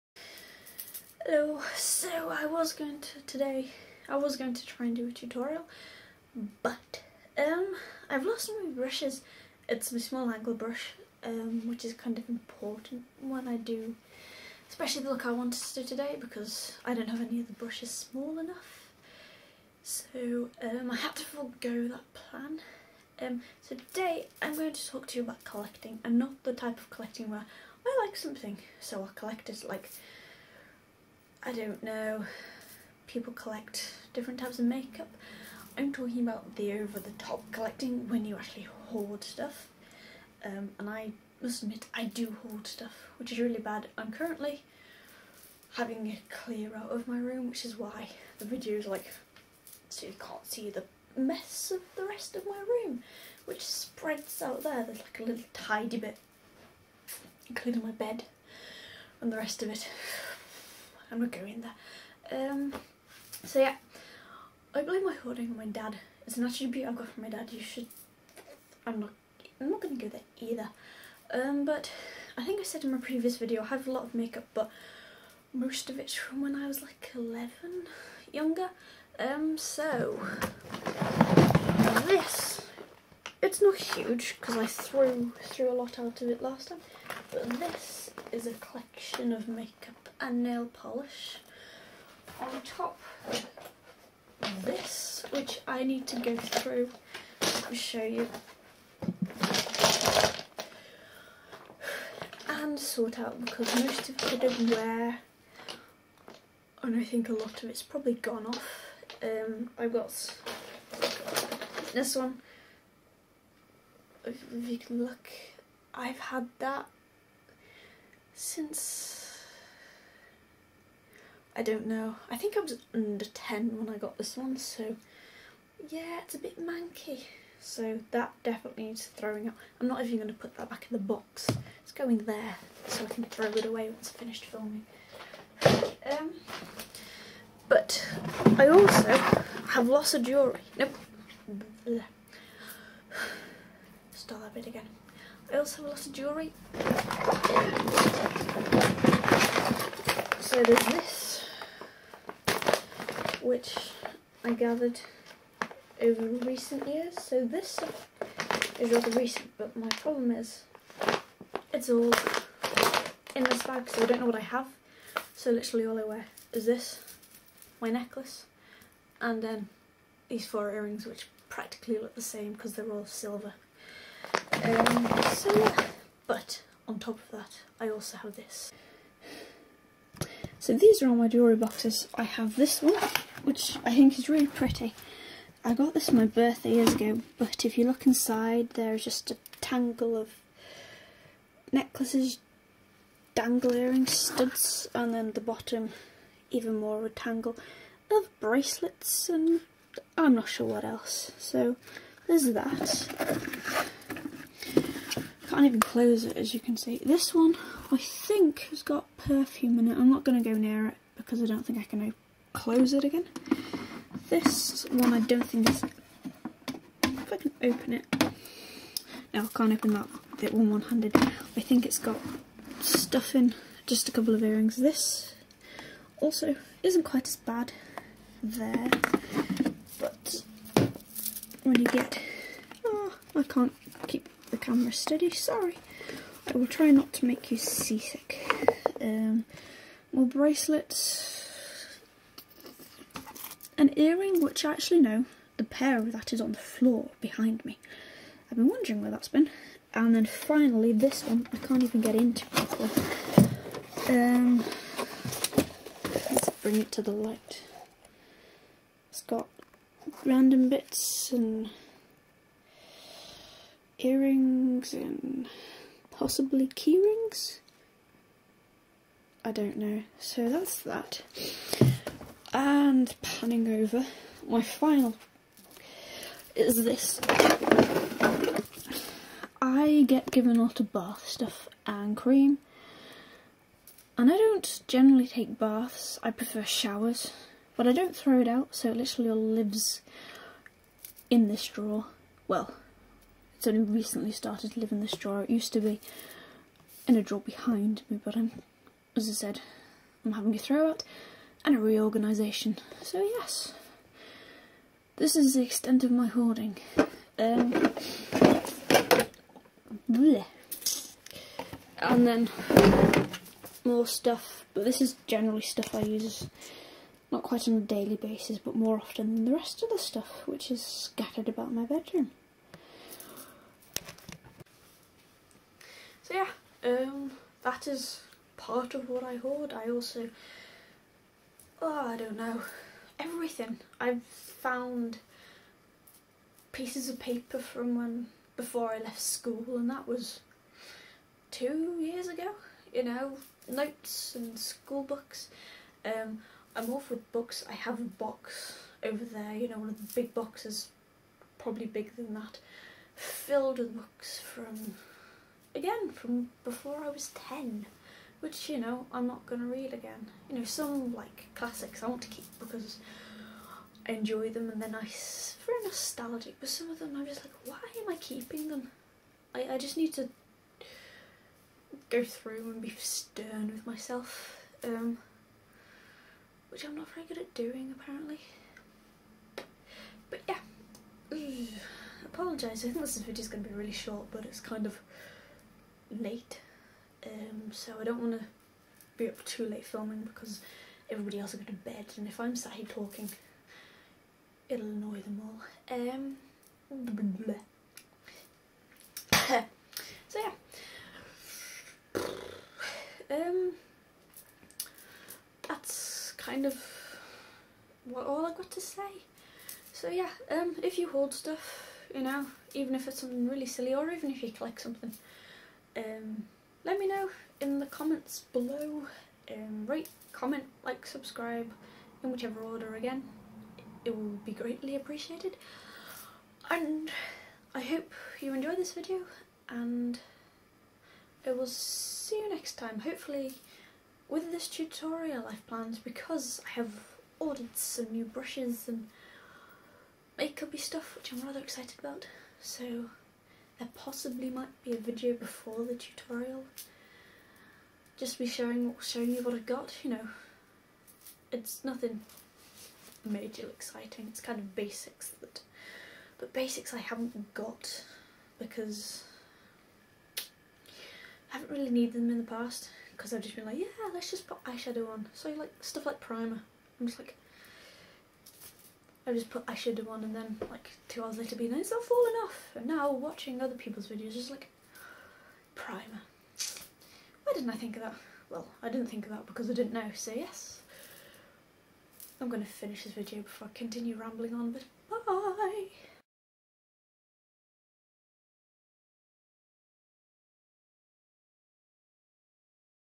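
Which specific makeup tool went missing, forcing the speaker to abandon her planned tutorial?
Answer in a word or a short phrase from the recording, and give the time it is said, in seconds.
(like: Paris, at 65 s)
small angle brush, at 9 s.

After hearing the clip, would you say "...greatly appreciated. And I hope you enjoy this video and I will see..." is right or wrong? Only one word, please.
right.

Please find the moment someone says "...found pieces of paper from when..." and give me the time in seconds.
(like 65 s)
334 s.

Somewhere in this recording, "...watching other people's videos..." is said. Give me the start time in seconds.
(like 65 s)
473 s.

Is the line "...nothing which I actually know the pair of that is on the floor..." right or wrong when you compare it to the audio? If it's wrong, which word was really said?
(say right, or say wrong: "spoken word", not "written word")
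wrong: "earring", not "nothing".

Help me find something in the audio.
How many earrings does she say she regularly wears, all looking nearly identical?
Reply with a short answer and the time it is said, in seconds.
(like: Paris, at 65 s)
4, at 170 s.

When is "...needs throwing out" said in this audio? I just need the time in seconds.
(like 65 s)
128 s.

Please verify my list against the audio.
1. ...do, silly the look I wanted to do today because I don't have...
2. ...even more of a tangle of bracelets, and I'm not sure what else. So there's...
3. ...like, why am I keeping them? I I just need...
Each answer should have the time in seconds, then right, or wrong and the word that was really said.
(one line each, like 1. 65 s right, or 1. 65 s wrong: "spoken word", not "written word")
1. 13 s wrong: "especially", not "silly"
2. 196 s right
3. 367 s right.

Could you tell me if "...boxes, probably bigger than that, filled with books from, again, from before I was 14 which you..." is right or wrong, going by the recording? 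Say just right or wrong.
wrong.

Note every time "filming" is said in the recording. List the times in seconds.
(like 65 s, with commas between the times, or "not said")
134 s, 389 s.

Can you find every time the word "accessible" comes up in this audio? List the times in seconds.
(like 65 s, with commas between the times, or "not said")
not said.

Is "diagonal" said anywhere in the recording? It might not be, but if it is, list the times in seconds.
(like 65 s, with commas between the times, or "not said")
not said.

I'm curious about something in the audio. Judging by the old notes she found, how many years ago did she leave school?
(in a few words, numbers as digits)
2.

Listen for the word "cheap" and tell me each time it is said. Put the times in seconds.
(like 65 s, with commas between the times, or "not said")
not said.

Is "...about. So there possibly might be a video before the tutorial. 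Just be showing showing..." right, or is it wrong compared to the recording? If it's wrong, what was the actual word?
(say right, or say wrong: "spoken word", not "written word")
right.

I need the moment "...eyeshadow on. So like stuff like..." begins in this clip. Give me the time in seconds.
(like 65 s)
464 s.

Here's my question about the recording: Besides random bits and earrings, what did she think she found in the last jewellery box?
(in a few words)
keyrings.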